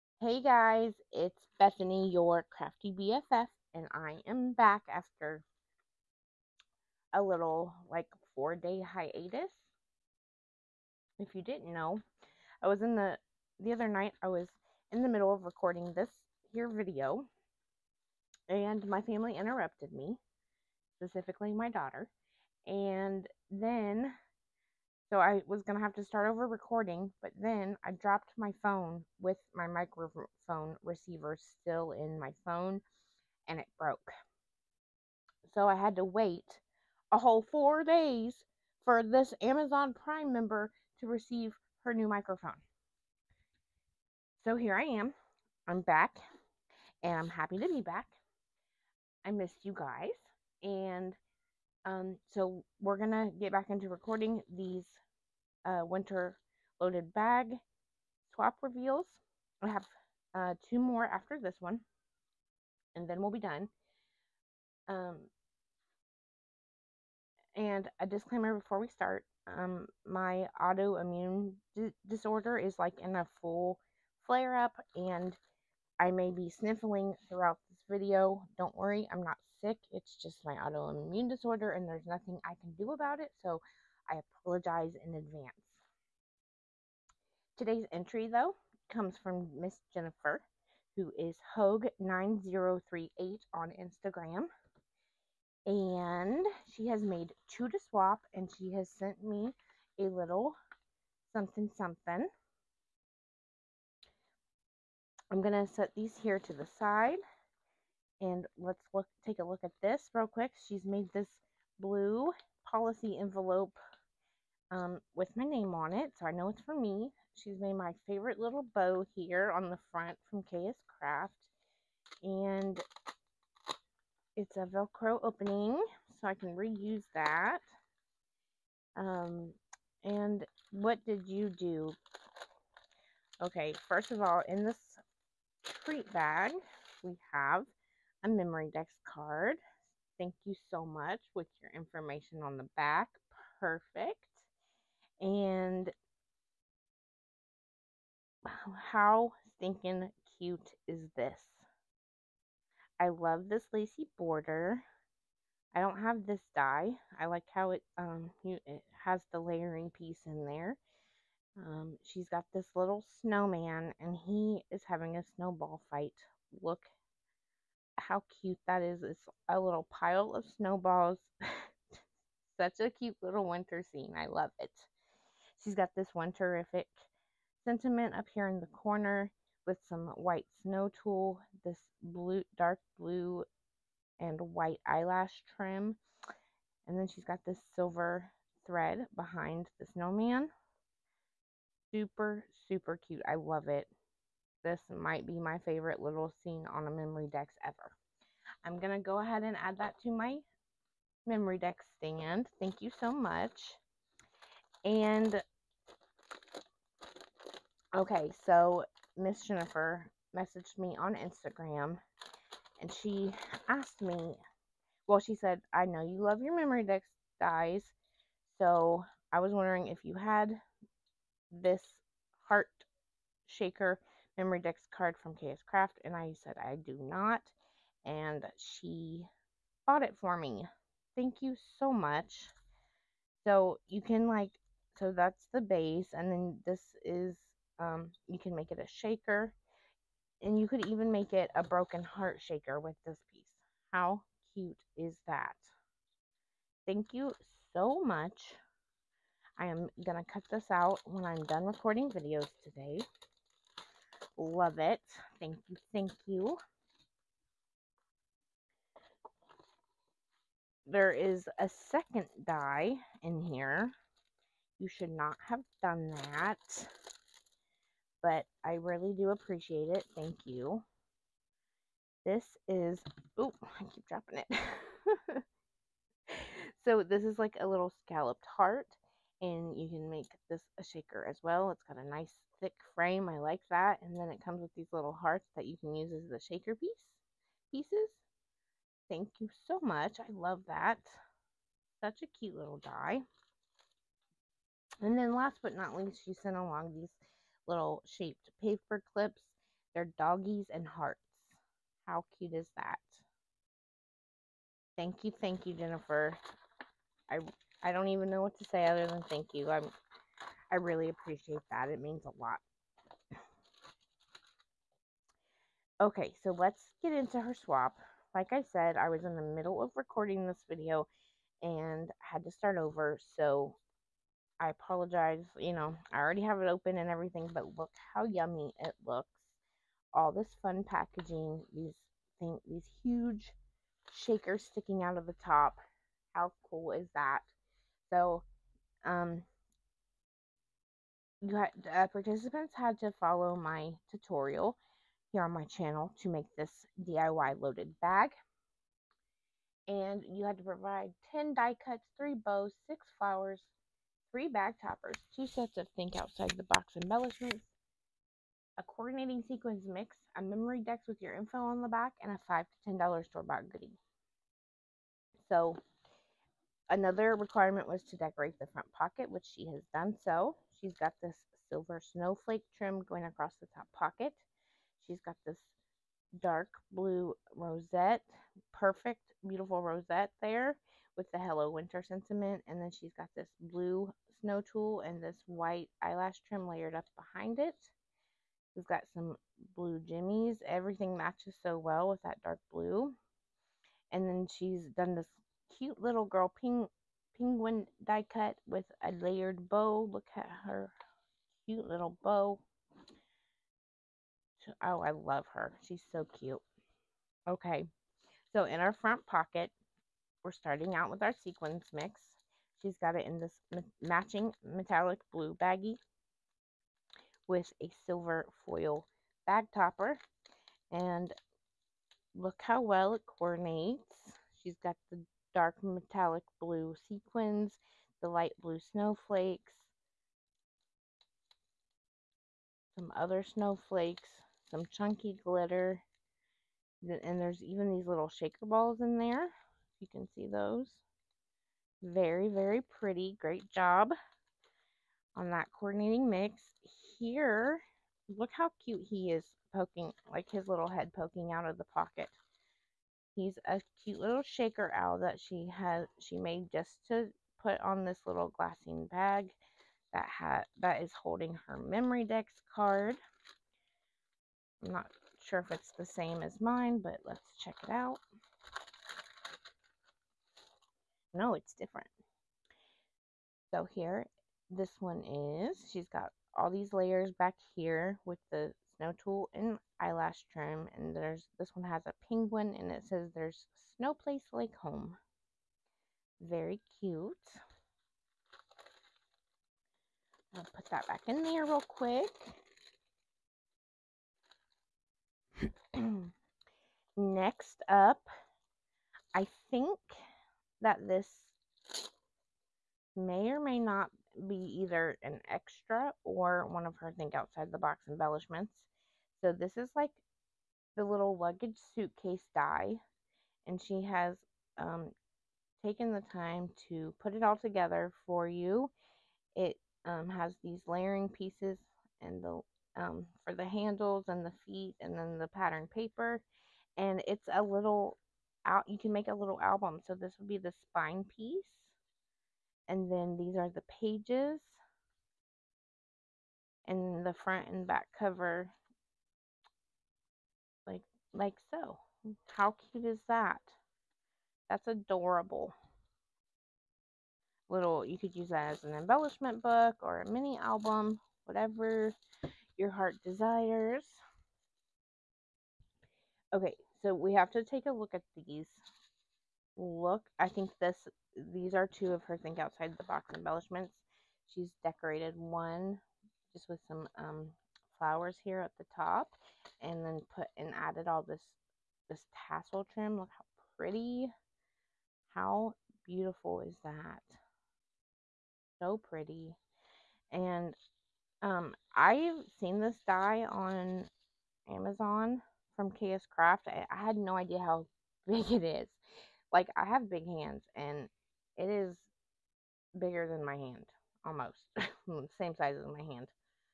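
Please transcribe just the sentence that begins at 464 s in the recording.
I'm not sure if it's the same as mine, but let's check it out.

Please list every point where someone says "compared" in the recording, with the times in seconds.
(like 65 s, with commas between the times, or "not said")
not said.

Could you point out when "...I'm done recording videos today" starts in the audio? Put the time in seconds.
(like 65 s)
251 s.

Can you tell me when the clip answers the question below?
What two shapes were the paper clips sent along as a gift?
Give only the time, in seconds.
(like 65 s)
300 s.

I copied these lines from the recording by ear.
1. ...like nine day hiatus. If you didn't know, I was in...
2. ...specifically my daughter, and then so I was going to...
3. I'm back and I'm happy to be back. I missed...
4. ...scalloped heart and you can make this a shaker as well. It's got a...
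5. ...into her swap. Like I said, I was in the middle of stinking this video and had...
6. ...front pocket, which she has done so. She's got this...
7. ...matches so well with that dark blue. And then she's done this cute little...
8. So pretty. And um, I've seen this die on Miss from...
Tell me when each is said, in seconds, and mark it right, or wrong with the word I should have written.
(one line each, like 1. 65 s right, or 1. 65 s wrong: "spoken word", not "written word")
1. 7 s wrong: "four", not "nine"
2. 20 s right
3. 45 s right
4. 278 s right
5. 317 s wrong: "recording", not "stinking"
6. 368 s right
7. 391 s right
8. 578 s wrong: "Amazon", not "Miss".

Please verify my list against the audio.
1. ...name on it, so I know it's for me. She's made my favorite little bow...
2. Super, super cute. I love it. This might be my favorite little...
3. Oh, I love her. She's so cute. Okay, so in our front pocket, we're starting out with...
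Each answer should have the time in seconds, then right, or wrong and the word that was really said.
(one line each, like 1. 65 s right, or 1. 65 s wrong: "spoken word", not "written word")
1. 115 s right
2. 191 s right
3. 404 s right.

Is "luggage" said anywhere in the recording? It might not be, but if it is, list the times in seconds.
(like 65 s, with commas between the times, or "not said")
511 s.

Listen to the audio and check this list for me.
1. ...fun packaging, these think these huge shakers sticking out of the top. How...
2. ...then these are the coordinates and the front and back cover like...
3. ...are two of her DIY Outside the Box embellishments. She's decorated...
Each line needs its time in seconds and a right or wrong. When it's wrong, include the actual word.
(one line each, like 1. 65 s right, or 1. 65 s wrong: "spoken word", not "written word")
1. 330 s right
2. 533 s wrong: "pages", not "coordinates"
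3. 561 s wrong: "Think", not "DIY".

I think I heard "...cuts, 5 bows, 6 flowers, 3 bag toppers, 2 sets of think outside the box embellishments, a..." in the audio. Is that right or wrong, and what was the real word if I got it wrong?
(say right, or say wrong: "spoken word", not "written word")
wrong: "3", not "5".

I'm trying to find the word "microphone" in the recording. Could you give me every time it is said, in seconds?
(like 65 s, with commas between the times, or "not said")
29 s, 42 s.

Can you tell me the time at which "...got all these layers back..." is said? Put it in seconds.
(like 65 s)
476 s.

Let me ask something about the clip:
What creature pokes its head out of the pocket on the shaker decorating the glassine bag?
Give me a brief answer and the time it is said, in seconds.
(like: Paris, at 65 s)
owl, at 454 s.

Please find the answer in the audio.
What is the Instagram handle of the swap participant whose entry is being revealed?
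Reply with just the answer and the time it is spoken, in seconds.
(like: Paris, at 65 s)
Hogue9038, at 91 s.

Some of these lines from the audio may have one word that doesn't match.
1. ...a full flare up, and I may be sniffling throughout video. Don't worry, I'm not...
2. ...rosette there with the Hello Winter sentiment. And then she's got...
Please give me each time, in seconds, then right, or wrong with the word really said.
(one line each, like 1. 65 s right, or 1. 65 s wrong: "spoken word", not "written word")
1. 73 s right
2. 379 s right.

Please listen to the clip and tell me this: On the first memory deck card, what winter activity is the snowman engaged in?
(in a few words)
a snowball fight.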